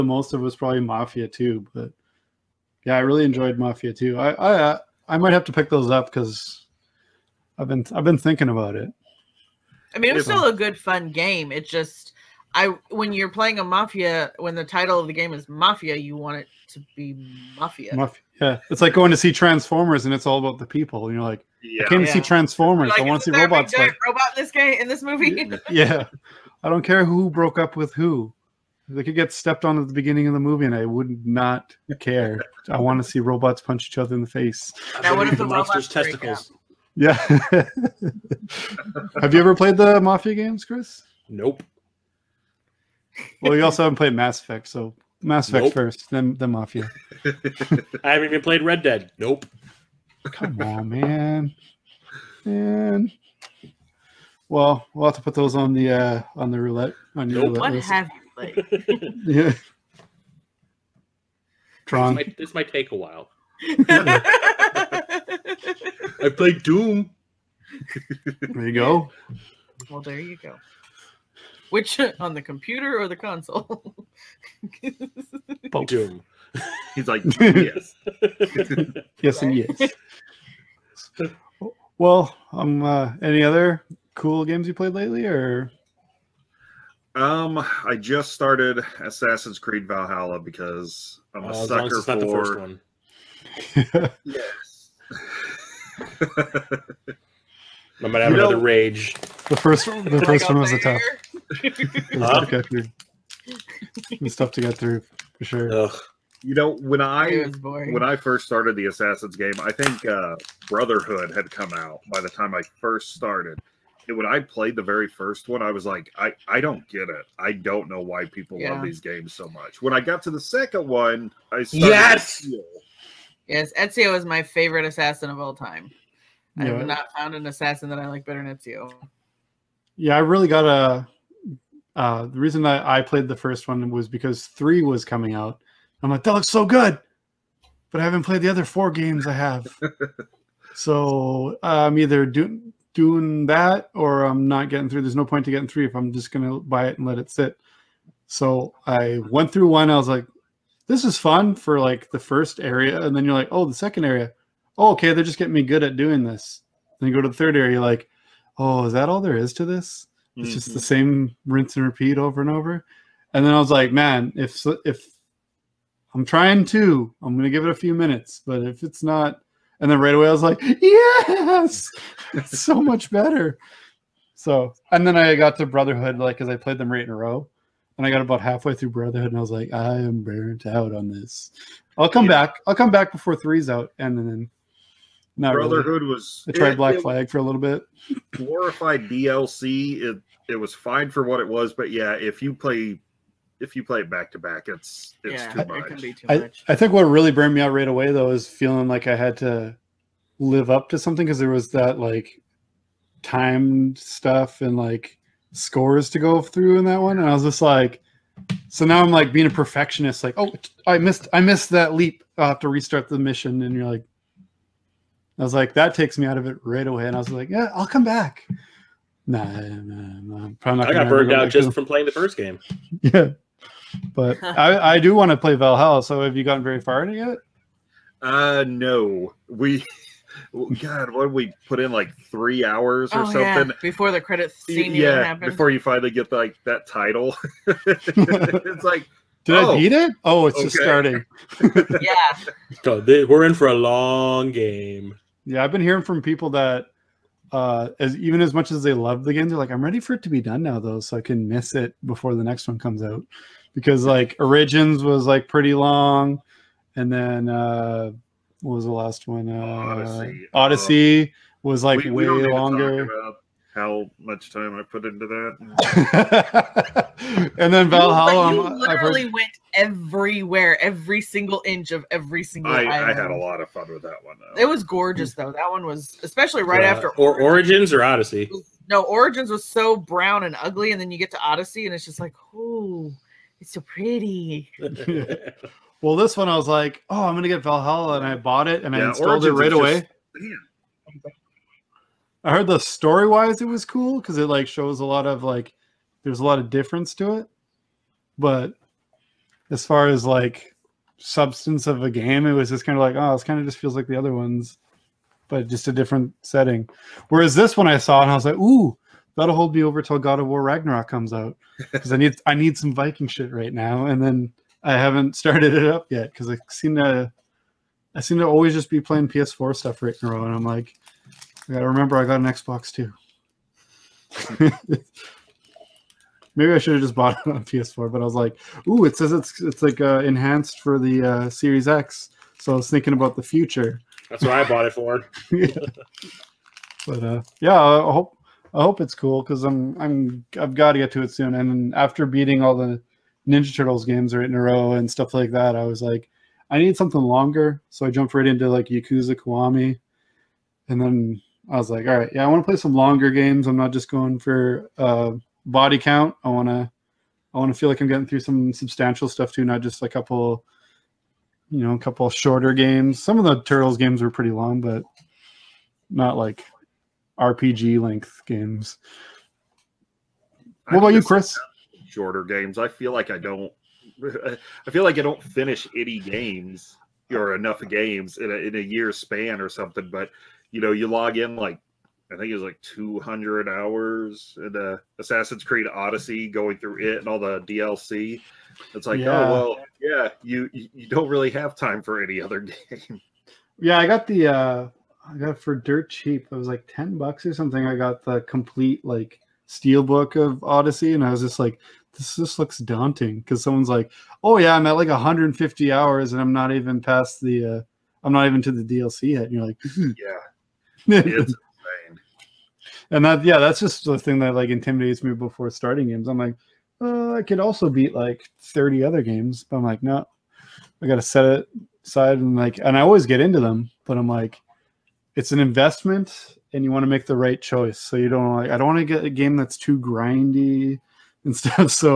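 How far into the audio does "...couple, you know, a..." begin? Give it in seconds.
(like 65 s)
360 s.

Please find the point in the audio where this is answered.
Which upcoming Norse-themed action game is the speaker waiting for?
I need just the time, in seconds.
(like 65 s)
310 s.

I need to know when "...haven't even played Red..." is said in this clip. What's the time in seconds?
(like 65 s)
48 s.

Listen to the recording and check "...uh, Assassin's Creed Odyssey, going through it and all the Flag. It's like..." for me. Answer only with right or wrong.
wrong.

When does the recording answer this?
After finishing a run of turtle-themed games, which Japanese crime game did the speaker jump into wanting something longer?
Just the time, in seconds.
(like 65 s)
348 s.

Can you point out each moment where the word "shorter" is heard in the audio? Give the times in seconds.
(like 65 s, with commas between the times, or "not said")
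362 s, 372 s.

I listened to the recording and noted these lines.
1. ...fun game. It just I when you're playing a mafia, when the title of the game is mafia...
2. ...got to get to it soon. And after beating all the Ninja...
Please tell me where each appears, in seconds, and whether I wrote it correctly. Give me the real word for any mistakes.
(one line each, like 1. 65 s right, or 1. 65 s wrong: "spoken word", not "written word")
1. 10 s right
2. 340 s right.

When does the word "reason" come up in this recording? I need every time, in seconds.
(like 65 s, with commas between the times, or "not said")
132 s.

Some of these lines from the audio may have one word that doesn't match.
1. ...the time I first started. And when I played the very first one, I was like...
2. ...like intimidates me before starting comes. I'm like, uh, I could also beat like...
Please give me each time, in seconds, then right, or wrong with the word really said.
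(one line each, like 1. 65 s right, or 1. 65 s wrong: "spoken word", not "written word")
1. 112 s right
2. 414 s wrong: "games", not "comes".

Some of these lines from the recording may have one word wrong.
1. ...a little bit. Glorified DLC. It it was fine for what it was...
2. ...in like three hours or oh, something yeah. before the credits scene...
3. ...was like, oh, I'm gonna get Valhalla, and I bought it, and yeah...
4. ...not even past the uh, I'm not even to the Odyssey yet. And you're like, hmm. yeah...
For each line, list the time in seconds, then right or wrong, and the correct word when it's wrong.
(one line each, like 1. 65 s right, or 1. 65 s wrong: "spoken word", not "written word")
1. 187 s right
2. 231 s right
3. 286 s right
4. 406 s wrong: "DLC", not "Odyssey".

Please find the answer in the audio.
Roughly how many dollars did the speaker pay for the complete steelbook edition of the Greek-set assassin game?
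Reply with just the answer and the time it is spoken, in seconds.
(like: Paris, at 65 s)
10, at 396 s.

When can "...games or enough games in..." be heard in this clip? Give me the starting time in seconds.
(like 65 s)
376 s.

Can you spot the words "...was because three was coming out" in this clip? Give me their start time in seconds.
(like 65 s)
133 s.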